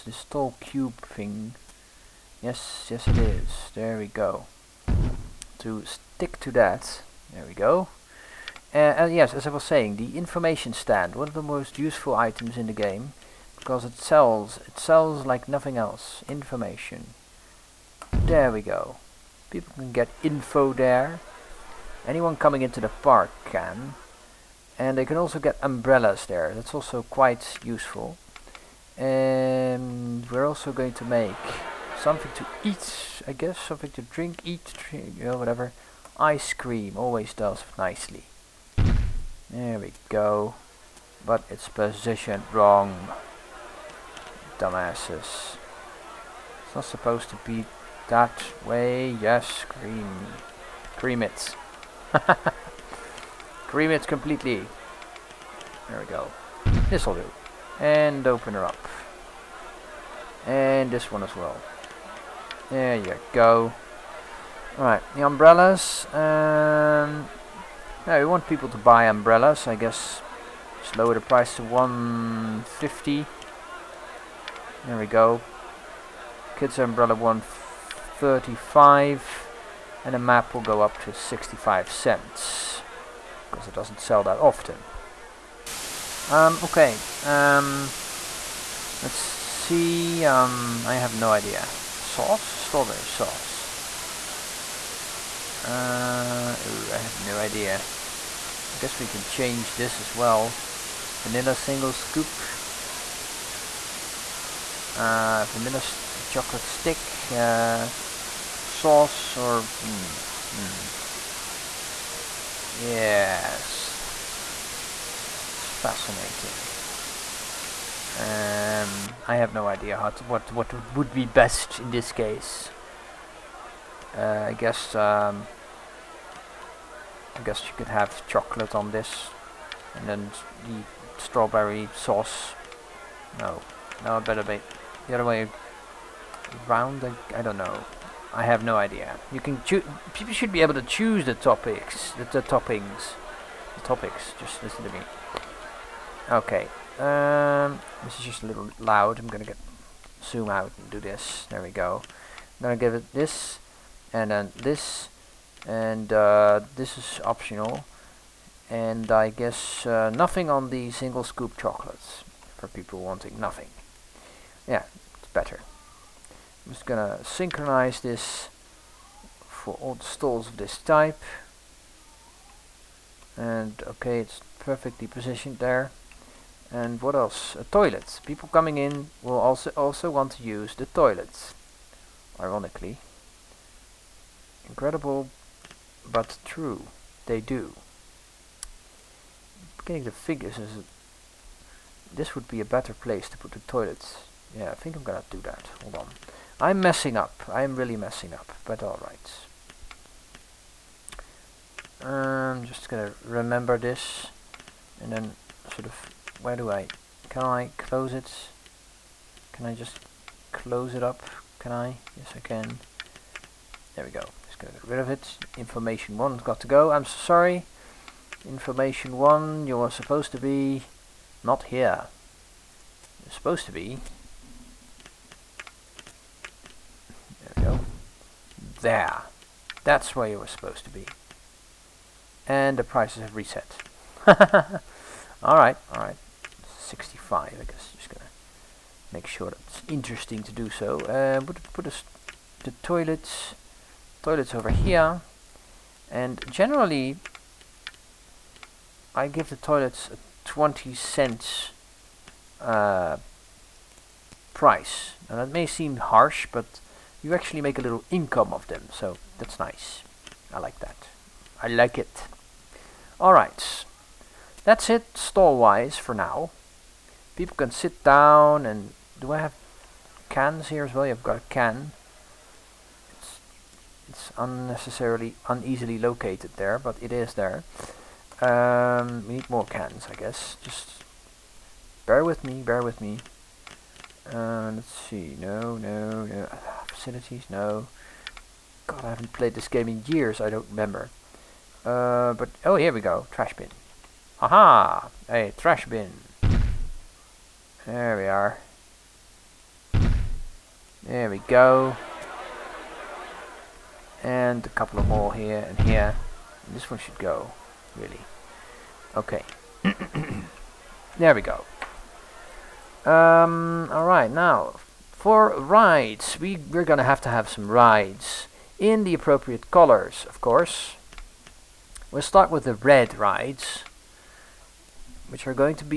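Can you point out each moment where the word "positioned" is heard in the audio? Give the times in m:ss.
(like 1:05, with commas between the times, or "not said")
0:41, 2:55.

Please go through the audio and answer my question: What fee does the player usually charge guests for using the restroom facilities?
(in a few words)
20 cents.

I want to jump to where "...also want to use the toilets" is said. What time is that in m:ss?
2:59.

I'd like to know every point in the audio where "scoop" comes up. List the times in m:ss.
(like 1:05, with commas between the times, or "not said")
1:41, 2:41.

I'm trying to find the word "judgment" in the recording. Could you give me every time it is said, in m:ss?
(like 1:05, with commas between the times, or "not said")
not said.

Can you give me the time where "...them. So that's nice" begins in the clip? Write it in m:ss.
4:18.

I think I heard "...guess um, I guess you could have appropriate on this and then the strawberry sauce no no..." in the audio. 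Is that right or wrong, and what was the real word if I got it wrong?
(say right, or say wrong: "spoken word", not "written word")
wrong: "chocolate", not "appropriate".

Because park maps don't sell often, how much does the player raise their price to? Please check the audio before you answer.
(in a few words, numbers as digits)
65 cents.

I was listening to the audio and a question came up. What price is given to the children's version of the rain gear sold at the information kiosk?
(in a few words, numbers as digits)
135.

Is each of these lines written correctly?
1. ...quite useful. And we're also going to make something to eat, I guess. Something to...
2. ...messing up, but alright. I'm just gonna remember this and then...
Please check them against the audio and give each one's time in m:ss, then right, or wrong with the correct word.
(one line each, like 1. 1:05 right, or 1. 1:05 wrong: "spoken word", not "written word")
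1. 0:27 right
2. 3:17 right.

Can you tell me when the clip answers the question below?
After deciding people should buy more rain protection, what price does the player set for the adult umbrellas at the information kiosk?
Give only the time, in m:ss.
1:11.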